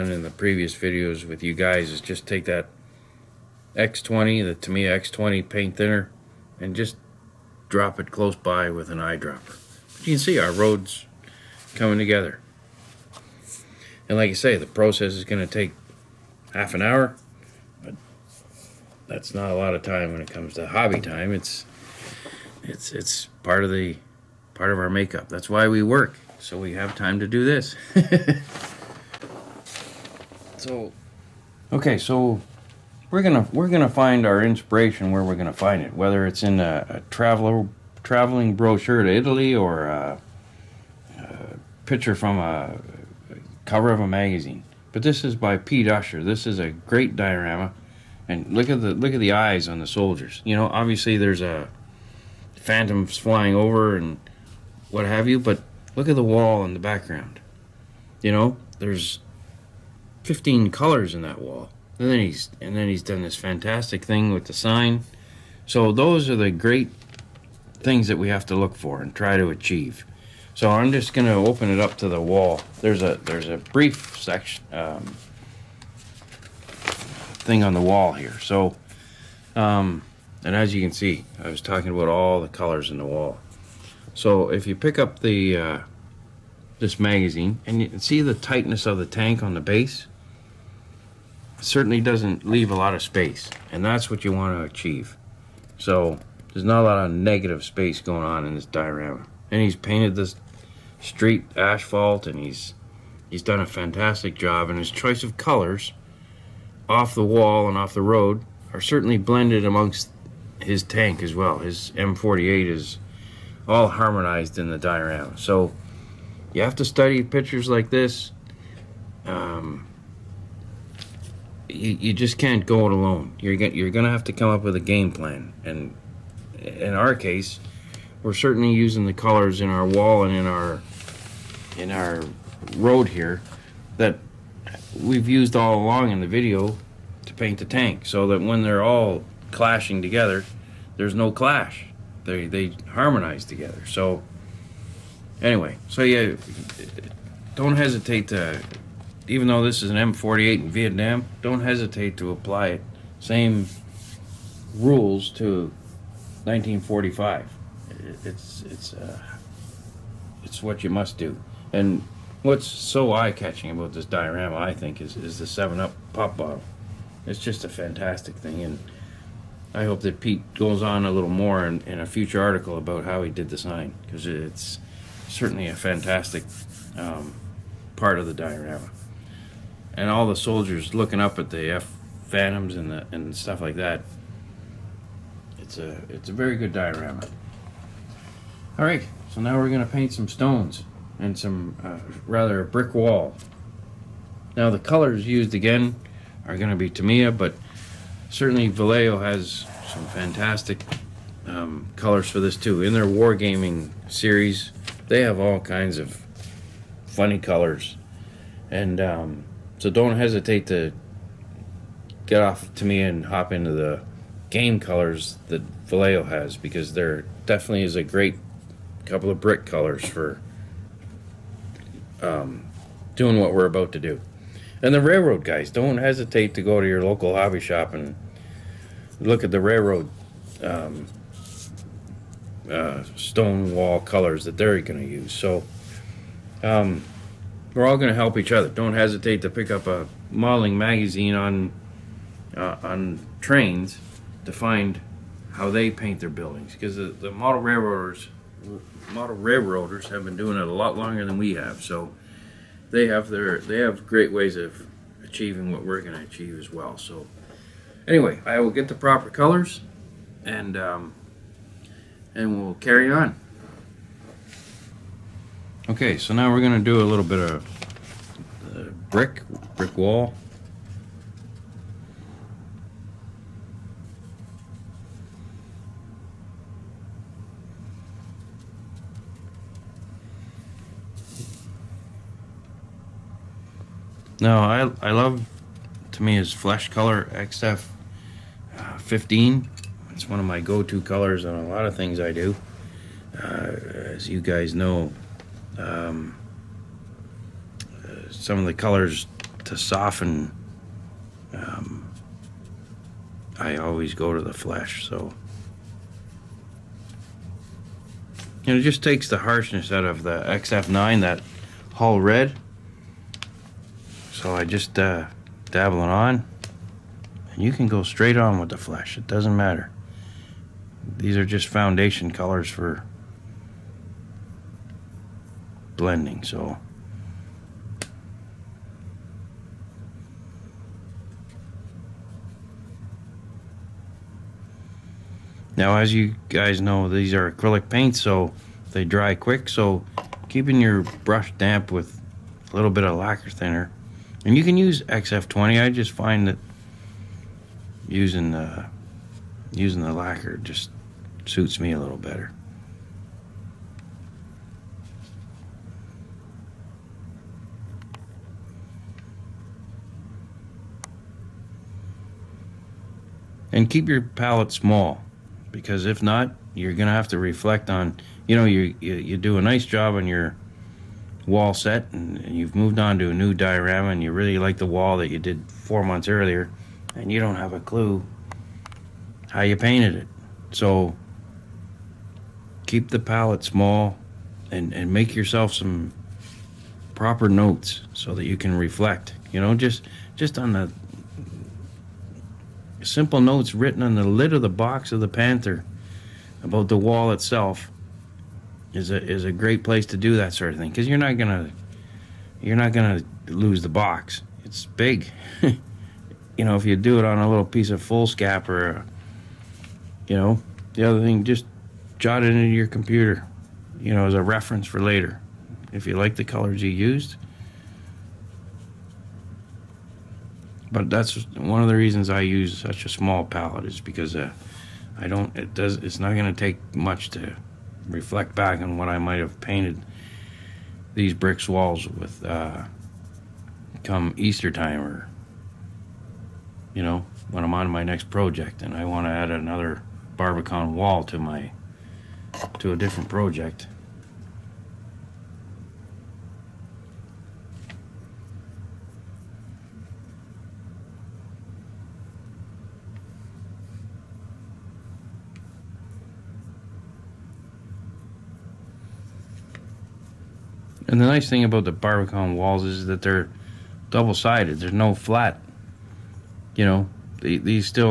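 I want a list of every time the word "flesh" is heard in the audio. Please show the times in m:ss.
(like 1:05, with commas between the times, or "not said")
4:46, 5:04, 5:18.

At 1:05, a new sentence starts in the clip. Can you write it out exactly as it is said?
So those are the great things that we have to look for and try to achieve.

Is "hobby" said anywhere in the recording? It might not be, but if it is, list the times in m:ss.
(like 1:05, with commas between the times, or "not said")
0:20, 3:47.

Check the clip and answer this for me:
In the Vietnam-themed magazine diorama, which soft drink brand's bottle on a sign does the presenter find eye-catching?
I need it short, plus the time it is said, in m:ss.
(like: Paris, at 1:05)
Seven Up, at 2:45.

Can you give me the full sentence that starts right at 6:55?
If you like the colors you used.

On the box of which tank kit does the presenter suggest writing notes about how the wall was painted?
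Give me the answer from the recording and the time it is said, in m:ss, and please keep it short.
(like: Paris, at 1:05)
Panther, at 6:35.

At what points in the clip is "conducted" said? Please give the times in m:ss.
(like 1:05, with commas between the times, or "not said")
not said.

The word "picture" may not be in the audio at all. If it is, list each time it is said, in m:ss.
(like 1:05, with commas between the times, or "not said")
0:41, 1:57.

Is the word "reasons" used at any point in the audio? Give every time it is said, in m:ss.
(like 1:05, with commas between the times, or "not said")
7:01.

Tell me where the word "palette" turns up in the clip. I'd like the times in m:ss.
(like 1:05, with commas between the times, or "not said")
6:04, 6:23, 7:03.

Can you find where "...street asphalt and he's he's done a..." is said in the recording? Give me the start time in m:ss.
1:40.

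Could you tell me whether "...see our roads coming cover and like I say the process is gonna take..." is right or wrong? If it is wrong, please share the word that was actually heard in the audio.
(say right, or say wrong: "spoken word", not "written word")
wrong: "together", not "cover".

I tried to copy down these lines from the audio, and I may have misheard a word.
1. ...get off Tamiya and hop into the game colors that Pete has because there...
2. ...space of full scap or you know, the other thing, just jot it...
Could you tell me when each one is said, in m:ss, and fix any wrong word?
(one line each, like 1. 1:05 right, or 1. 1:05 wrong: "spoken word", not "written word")
1. 3:32 wrong: "Vallejo", not "Pete"
2. 6:47 wrong: "piece", not "space".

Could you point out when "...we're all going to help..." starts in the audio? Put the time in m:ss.
3:57.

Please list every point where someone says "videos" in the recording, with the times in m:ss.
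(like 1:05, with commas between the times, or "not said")
0:00, 2:16.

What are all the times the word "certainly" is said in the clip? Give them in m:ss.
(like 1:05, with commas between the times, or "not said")
1:31, 1:48, 2:08, 2:55, 3:18.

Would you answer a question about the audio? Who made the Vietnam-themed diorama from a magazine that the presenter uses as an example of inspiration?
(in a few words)
Pete Usher.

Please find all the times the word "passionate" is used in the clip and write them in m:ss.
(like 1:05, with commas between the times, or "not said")
not said.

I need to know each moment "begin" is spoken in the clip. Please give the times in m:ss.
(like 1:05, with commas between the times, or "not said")
not said.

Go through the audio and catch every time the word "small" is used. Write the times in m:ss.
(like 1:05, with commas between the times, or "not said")
6:04, 6:23, 7:03.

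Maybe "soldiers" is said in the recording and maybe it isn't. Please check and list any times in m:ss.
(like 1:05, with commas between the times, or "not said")
0:49, 3:00.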